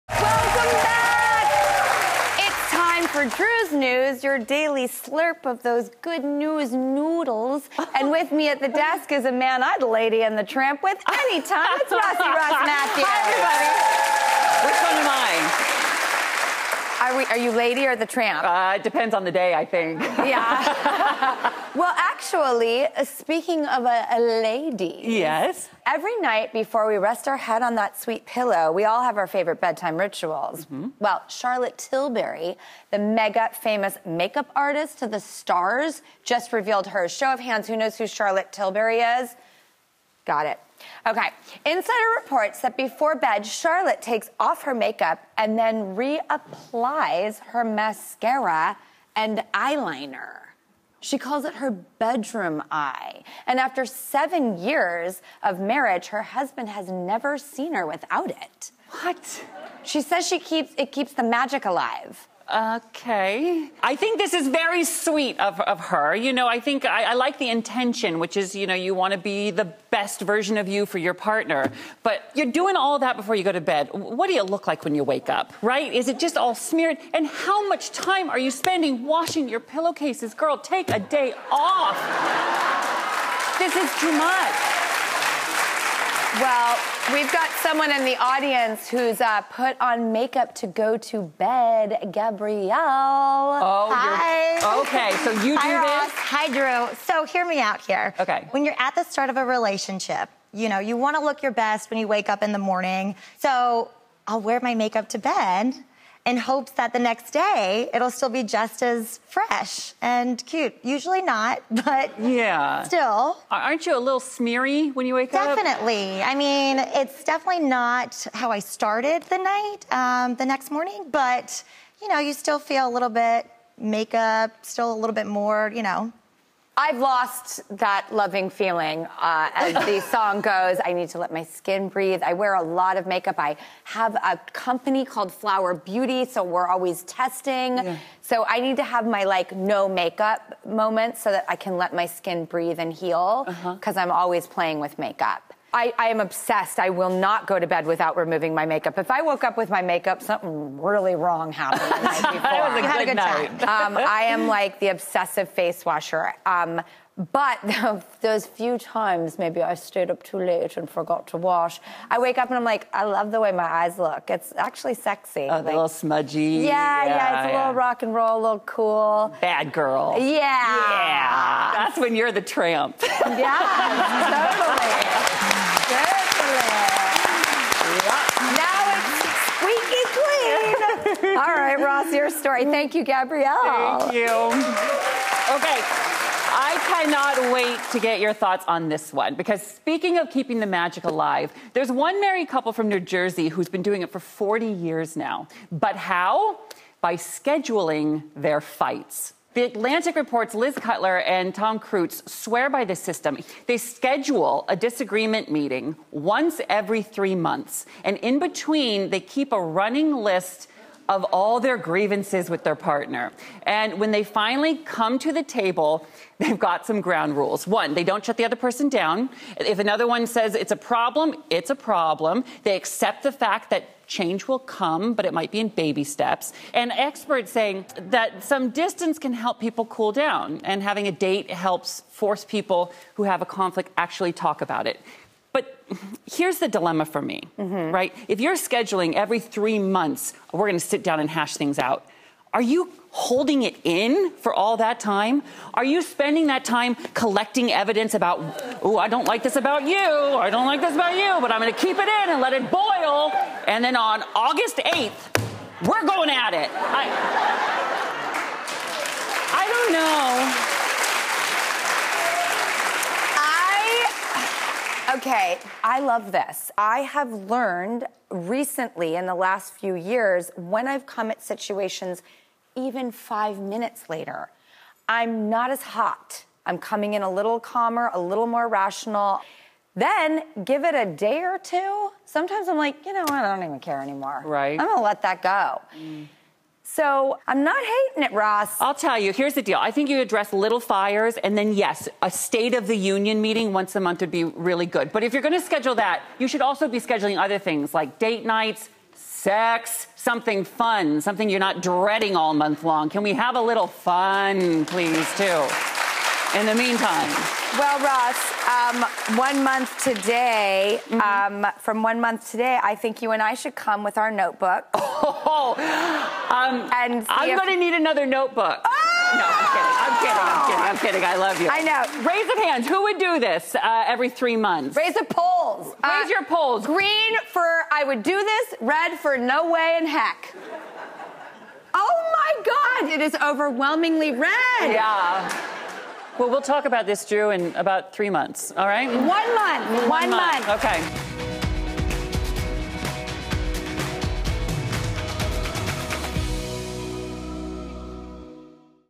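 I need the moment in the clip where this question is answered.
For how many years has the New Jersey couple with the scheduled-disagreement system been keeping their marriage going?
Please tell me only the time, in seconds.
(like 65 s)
194 s.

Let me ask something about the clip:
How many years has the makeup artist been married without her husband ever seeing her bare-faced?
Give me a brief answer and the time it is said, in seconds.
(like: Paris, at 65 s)
7, at 53 s.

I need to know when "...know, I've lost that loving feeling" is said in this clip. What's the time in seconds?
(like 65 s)
125 s.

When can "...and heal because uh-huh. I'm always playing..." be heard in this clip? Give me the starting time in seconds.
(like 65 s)
142 s.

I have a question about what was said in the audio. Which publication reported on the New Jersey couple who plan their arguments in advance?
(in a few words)
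The Atlantic.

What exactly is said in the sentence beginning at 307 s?
Well, Ross, um, one month today, mm-hmm.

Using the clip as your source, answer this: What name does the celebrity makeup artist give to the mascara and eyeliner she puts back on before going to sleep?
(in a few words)
Bedroom eye.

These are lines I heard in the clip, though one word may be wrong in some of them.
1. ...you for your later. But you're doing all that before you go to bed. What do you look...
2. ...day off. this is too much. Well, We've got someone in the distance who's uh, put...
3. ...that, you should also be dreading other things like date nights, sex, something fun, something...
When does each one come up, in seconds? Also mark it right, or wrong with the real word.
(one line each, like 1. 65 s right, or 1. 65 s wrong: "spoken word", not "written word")
1. 70 s wrong: "partner", not "later"
2. 80 s wrong: "audience", not "distance"
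3. 295 s wrong: "scheduling", not "dreading".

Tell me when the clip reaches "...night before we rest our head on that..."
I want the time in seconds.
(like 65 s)
26 s.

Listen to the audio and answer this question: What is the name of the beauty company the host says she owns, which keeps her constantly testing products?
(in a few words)
Flower Beauty.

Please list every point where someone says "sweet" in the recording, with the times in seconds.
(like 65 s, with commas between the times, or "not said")
27 s, 64 s.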